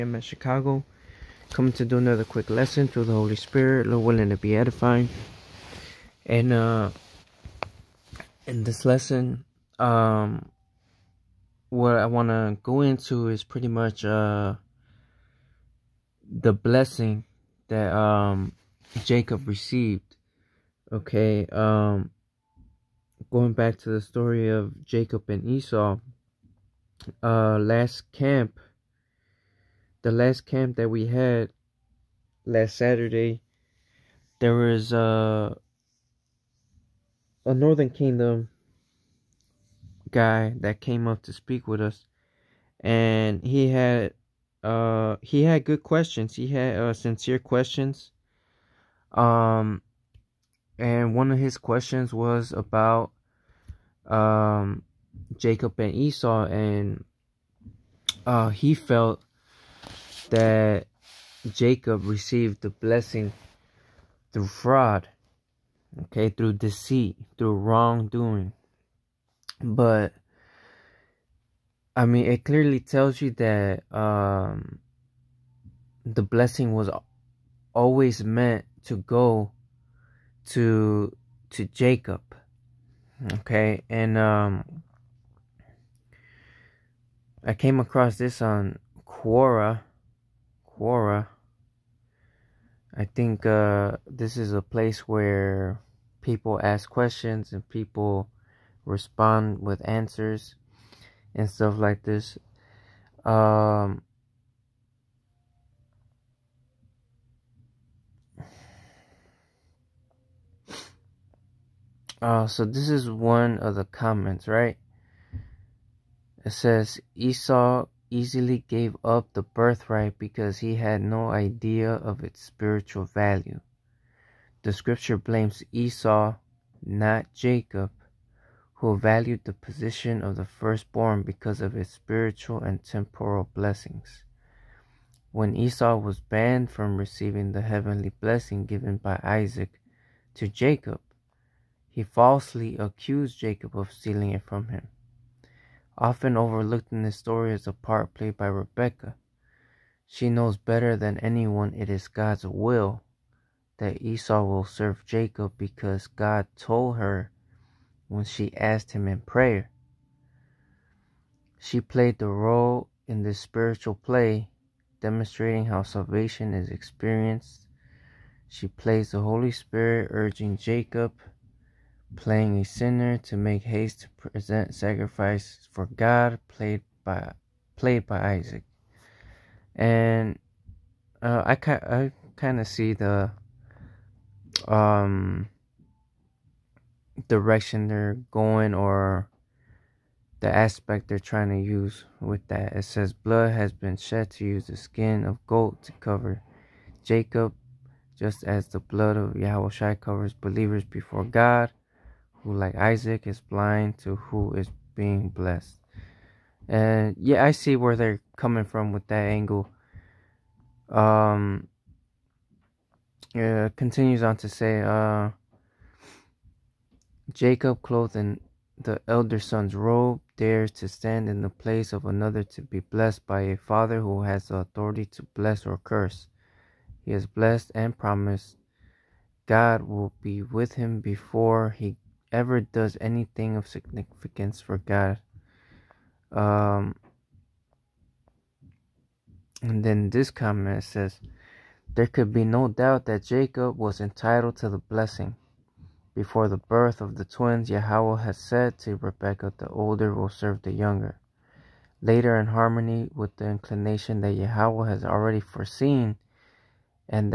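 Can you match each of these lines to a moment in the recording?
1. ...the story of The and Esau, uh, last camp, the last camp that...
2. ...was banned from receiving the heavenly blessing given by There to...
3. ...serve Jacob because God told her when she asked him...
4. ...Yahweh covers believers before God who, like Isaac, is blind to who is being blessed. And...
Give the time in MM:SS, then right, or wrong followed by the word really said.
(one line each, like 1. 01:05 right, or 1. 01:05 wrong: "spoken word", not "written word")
1. 00:23 wrong: "Jacob", not "The"
2. 02:15 wrong: "Isaac", not "There"
3. 02:34 right
4. 03:19 right.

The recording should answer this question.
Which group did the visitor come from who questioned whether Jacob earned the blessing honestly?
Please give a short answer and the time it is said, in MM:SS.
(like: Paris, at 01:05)
Northern Kingdom, at 00:37.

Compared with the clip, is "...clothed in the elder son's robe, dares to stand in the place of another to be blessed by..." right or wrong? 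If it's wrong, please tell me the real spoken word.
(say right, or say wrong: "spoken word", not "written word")
right.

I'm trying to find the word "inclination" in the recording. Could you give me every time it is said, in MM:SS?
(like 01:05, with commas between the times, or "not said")
04:13.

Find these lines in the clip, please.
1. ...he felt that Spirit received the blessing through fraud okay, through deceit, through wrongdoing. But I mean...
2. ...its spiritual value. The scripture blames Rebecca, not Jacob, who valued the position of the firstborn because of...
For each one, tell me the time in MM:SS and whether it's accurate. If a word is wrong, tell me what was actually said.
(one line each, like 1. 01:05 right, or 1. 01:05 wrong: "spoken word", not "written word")
1. 00:58 wrong: "Jacob", not "Spirit"
2. 02:02 wrong: "Esau", not "Rebecca".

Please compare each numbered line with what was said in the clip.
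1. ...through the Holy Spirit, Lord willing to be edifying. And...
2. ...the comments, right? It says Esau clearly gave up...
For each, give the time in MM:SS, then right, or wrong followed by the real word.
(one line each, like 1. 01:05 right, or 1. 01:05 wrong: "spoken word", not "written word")
1. 00:02 right
2. 01:53 wrong: "easily", not "clearly".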